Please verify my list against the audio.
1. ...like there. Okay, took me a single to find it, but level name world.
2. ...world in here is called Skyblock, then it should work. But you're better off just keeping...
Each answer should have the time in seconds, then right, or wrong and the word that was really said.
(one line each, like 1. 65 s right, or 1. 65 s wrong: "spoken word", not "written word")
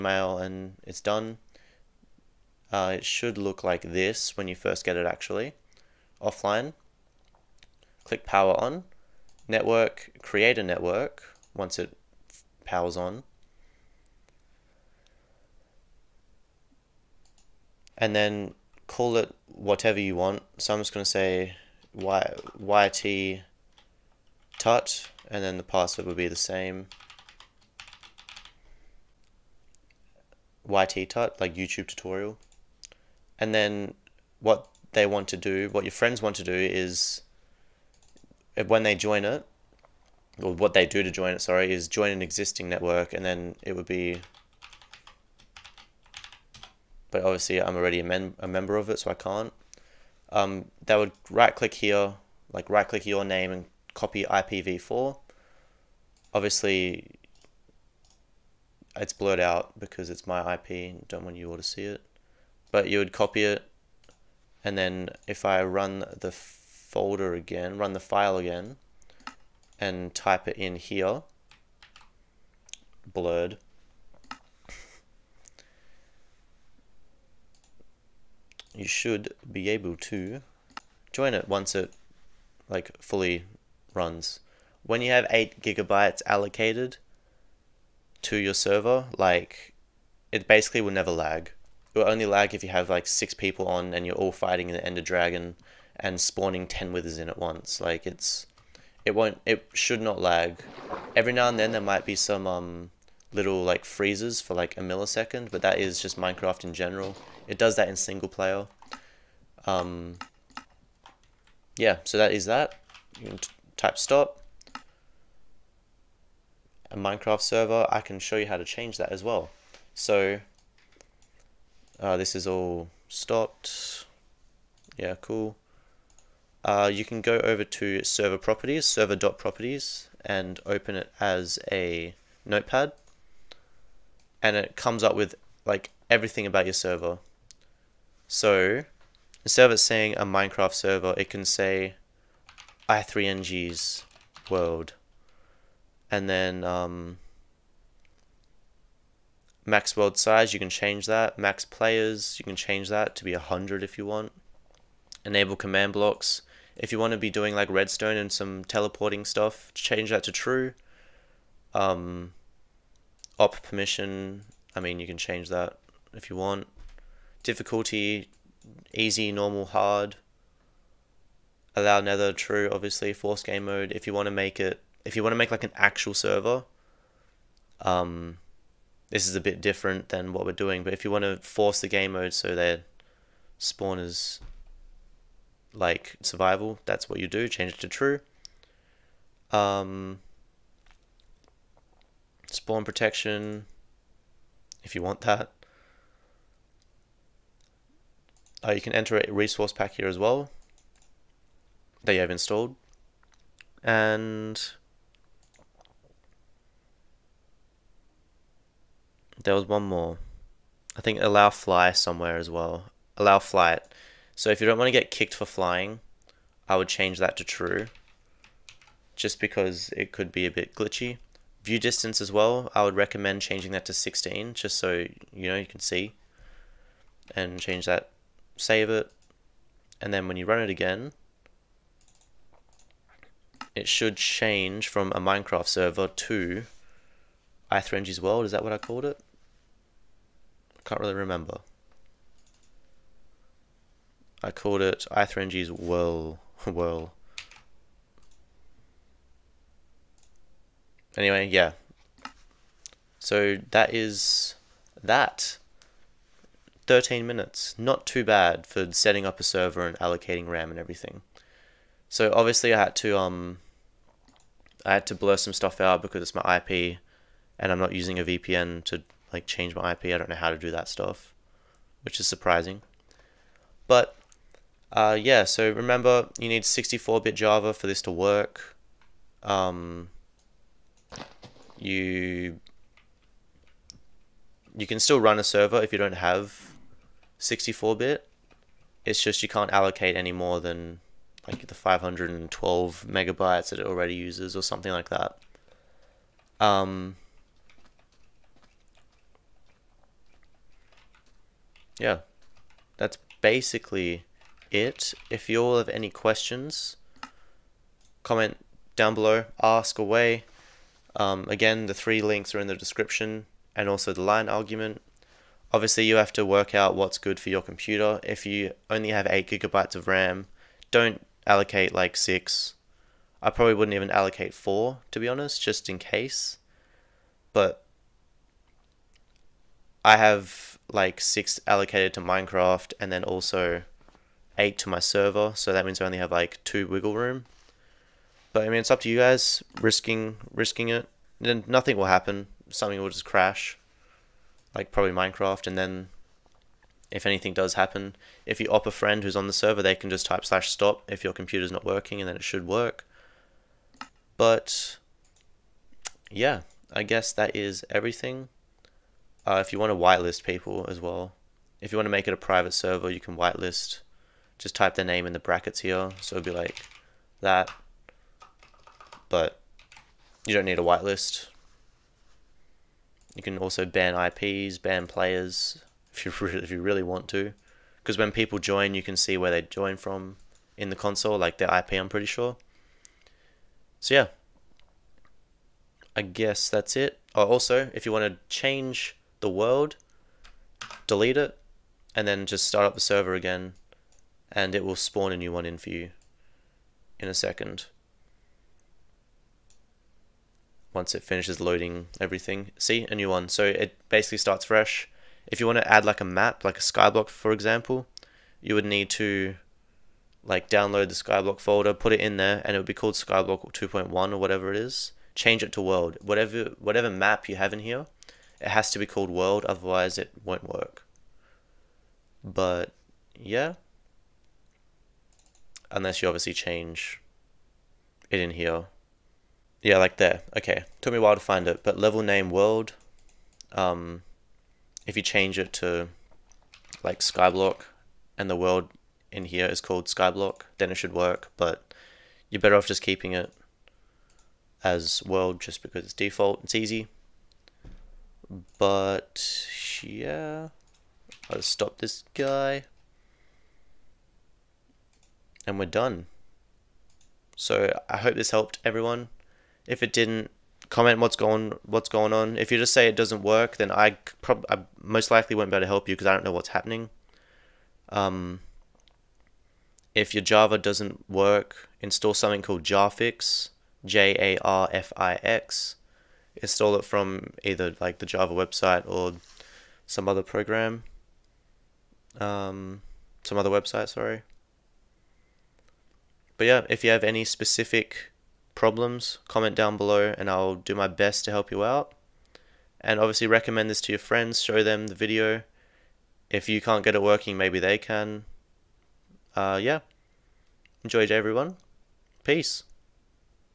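1. 429 s wrong: "while", not "single"
2. 438 s right.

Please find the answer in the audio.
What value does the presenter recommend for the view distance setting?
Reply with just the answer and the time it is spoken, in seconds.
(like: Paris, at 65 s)
16, at 223 s.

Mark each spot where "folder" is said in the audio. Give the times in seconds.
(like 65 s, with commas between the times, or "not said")
66 s, 411 s.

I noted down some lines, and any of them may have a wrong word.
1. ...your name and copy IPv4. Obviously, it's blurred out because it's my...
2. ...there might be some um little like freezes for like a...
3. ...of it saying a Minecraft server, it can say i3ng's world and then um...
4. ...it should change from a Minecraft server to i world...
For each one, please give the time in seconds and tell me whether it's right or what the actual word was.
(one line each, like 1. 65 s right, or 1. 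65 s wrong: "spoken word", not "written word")
1. 53 s right
2. 101 s right
3. 139 s right
4. 233 s right.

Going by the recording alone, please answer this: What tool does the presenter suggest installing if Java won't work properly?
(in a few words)
Jarfix.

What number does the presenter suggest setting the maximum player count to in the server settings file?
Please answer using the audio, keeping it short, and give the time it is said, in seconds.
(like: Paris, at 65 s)
100, at 153 s.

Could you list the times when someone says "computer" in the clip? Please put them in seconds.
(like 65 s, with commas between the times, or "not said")
317 s, 351 s.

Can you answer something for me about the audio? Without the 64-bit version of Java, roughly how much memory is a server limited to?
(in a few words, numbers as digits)
512 megabytes.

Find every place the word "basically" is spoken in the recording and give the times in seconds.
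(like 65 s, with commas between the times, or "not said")
90 s, 303 s, 404 s.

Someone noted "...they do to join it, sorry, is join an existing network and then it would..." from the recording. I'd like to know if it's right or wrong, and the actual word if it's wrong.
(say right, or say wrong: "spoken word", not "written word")
right.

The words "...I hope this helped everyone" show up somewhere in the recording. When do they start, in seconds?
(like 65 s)
458 s.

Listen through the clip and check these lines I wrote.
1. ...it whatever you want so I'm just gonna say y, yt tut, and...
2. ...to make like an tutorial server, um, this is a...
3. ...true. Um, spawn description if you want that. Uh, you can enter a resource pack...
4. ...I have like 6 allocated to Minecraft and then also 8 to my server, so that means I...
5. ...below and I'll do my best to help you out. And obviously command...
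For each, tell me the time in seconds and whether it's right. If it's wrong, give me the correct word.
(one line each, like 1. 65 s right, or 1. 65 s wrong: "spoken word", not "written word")
1. 19 s right
2. 175 s wrong: "actual", not "tutorial"
3. 187 s wrong: "protection", not "description"
4. 330 s right
5. 489 s wrong: "recommend", not "command".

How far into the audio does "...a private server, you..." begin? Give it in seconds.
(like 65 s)
362 s.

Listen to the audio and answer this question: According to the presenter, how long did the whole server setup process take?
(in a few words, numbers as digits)
13 minutes.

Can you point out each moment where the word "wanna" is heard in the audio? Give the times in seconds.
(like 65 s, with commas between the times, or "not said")
not said.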